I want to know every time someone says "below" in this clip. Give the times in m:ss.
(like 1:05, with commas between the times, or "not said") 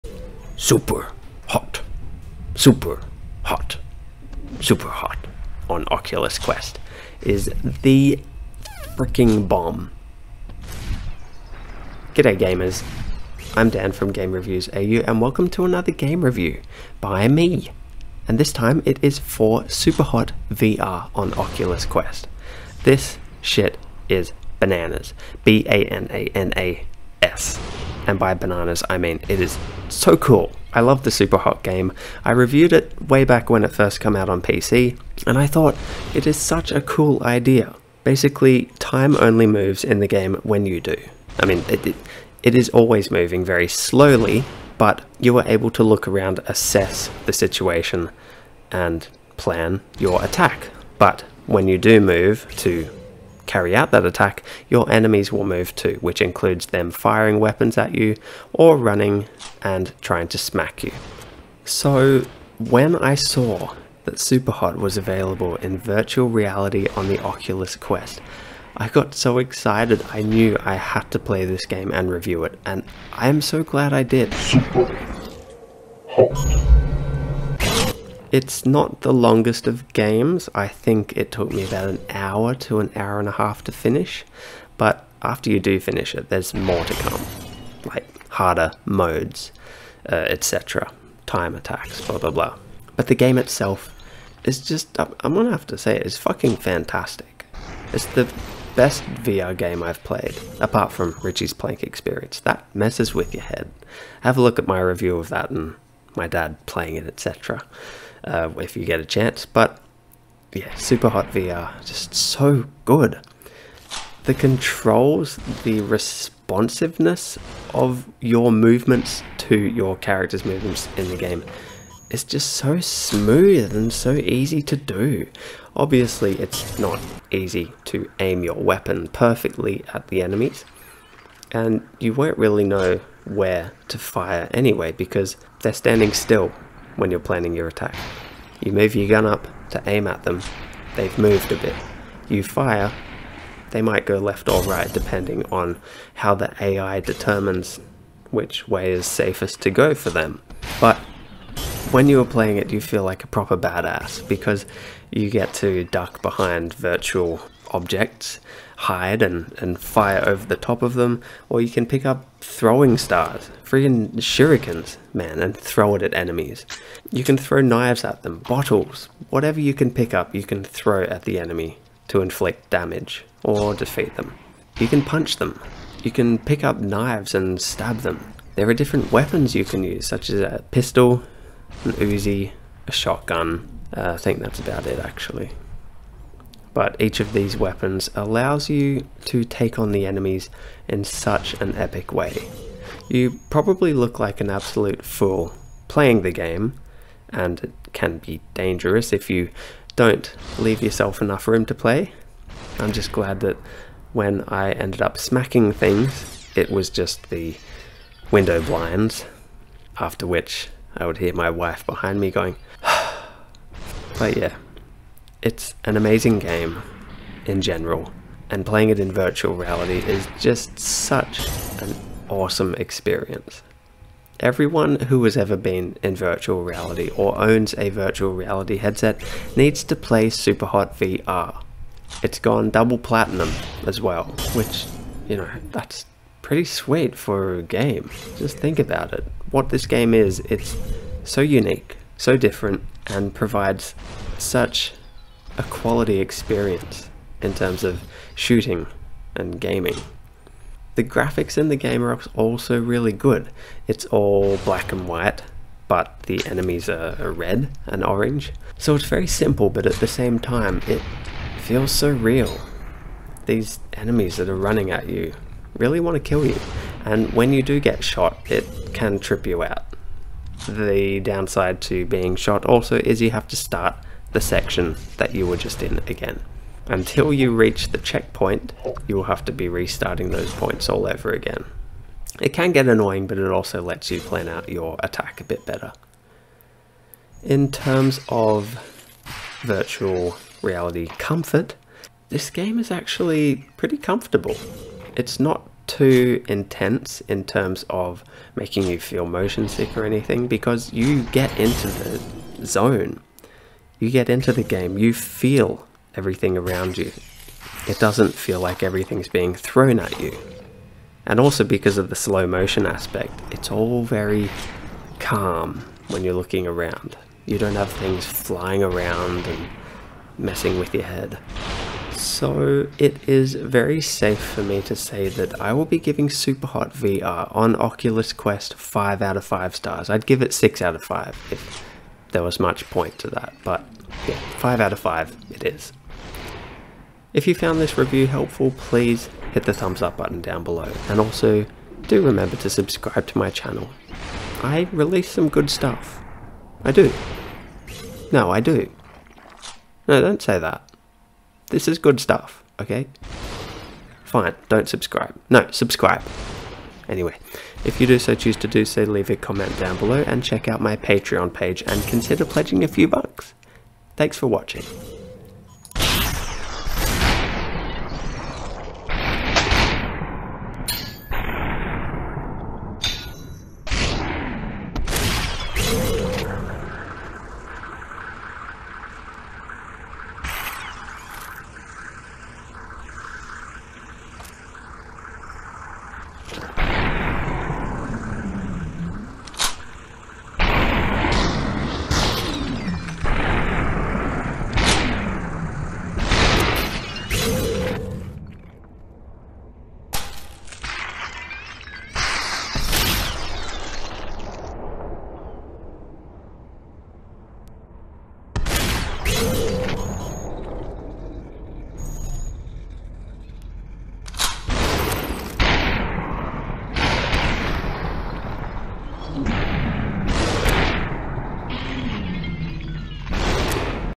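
5:40, 5:59.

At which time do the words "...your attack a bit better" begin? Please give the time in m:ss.
4:44.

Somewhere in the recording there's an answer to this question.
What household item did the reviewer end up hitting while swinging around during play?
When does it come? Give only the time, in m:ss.
3:27.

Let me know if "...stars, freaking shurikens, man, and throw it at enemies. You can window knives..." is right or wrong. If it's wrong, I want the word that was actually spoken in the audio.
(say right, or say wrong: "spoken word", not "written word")
wrong: "throw", not "window".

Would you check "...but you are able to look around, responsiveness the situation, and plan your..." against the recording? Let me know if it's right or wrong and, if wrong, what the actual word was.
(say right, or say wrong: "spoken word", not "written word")
wrong: "assess", not "responsiveness".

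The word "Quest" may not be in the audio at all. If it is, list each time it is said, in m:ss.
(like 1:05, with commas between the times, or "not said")
0:06, 0:21, 1:07, 5:28.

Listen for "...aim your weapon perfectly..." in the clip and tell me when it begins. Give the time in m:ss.
2:08.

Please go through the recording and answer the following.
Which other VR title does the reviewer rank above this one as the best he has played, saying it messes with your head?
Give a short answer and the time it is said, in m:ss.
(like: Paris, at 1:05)
Richie's Plank Experience, at 1:41.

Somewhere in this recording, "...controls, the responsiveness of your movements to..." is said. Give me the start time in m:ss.
1:54.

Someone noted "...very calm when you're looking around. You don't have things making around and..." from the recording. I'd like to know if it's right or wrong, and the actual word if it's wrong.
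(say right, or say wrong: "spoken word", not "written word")
wrong: "flying", not "making".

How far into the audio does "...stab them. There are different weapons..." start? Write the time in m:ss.
2:57.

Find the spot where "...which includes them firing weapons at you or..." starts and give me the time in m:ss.
0:55.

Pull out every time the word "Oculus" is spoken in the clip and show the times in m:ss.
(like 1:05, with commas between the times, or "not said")
0:05, 0:21, 1:07, 5:27.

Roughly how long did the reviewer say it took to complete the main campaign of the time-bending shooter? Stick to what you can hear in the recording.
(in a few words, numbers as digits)
an hour to an hour and a half.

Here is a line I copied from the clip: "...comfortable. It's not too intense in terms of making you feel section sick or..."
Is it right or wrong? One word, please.
wrong.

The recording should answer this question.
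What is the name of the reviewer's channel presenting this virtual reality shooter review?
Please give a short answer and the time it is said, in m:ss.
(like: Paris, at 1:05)
Game Reviews AU, at 0:14.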